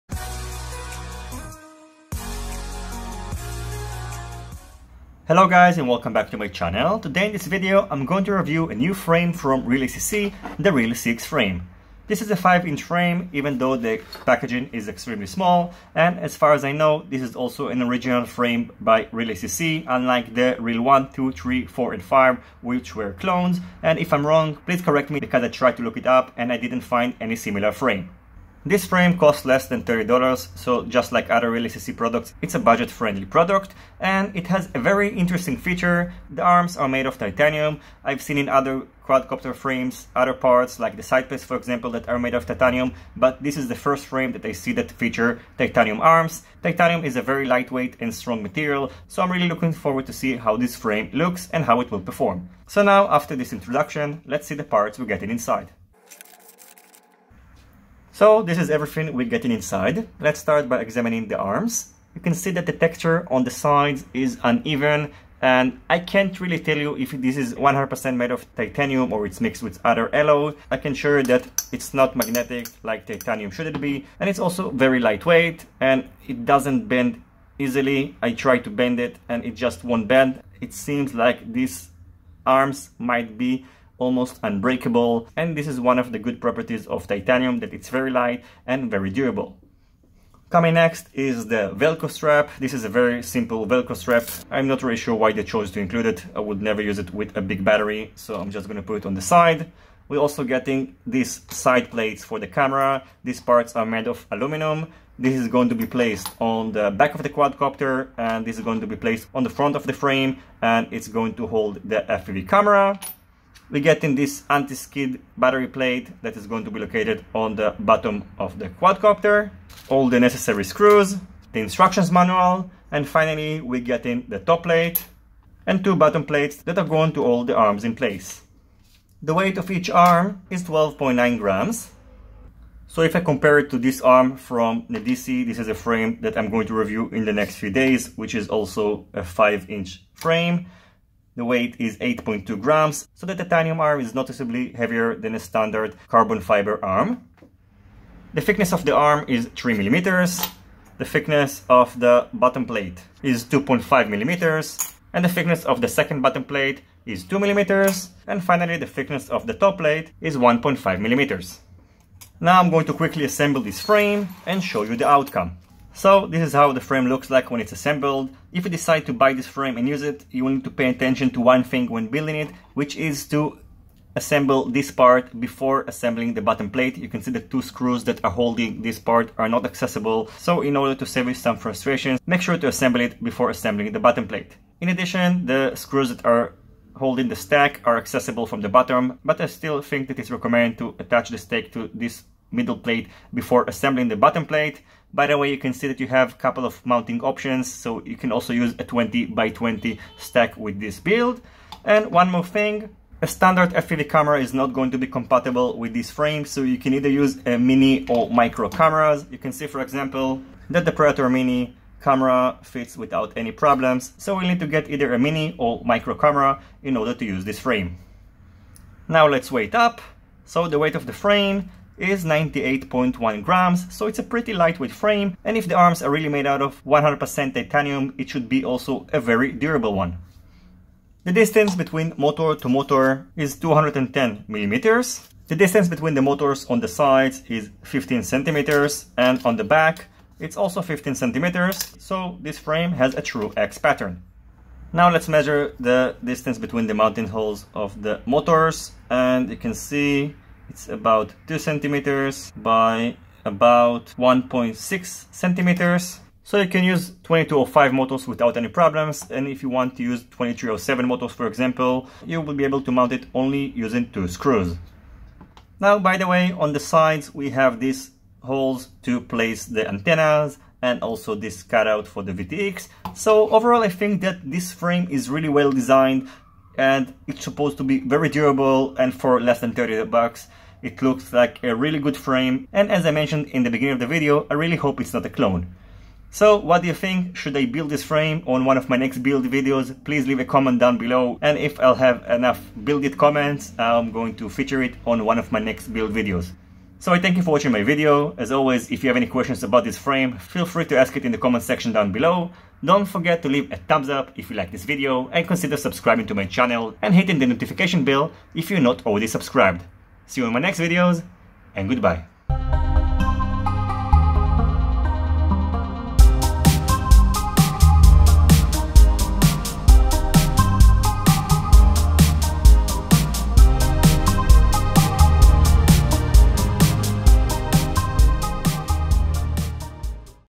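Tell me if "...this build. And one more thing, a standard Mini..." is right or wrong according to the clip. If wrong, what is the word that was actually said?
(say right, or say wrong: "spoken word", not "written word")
wrong: "FPV", not "Mini".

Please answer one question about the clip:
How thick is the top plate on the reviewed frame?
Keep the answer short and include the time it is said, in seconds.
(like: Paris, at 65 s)
1.5 millimeters, at 160 s.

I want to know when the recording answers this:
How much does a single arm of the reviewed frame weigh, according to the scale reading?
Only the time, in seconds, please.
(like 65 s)
130 s.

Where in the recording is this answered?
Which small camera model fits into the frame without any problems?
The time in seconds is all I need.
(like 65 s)
210 s.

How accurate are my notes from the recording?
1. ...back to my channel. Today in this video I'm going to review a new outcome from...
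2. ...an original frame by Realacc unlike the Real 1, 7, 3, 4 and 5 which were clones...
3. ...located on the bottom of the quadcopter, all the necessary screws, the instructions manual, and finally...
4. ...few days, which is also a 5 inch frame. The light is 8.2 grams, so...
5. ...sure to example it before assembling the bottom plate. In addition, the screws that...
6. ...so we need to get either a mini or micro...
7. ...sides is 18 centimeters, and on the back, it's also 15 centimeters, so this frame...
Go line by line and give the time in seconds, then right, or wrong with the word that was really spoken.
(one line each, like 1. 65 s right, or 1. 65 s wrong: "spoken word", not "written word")
1. 6 s wrong: "frame", not "outcome"
2. 17 s wrong: "2", not "7"
3. 116 s right
4. 137 s wrong: "weight", not "light"
5. 182 s wrong: "assemble", not "example"
6. 214 s right
7. 236 s wrong: "15", not "18".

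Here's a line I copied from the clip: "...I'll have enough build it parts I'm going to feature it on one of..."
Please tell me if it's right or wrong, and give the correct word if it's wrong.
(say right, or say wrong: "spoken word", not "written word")
wrong: "comments", not "parts".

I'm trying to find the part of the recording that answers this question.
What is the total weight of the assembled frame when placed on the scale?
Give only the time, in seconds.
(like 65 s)
222 s.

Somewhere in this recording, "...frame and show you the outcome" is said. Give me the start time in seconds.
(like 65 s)
163 s.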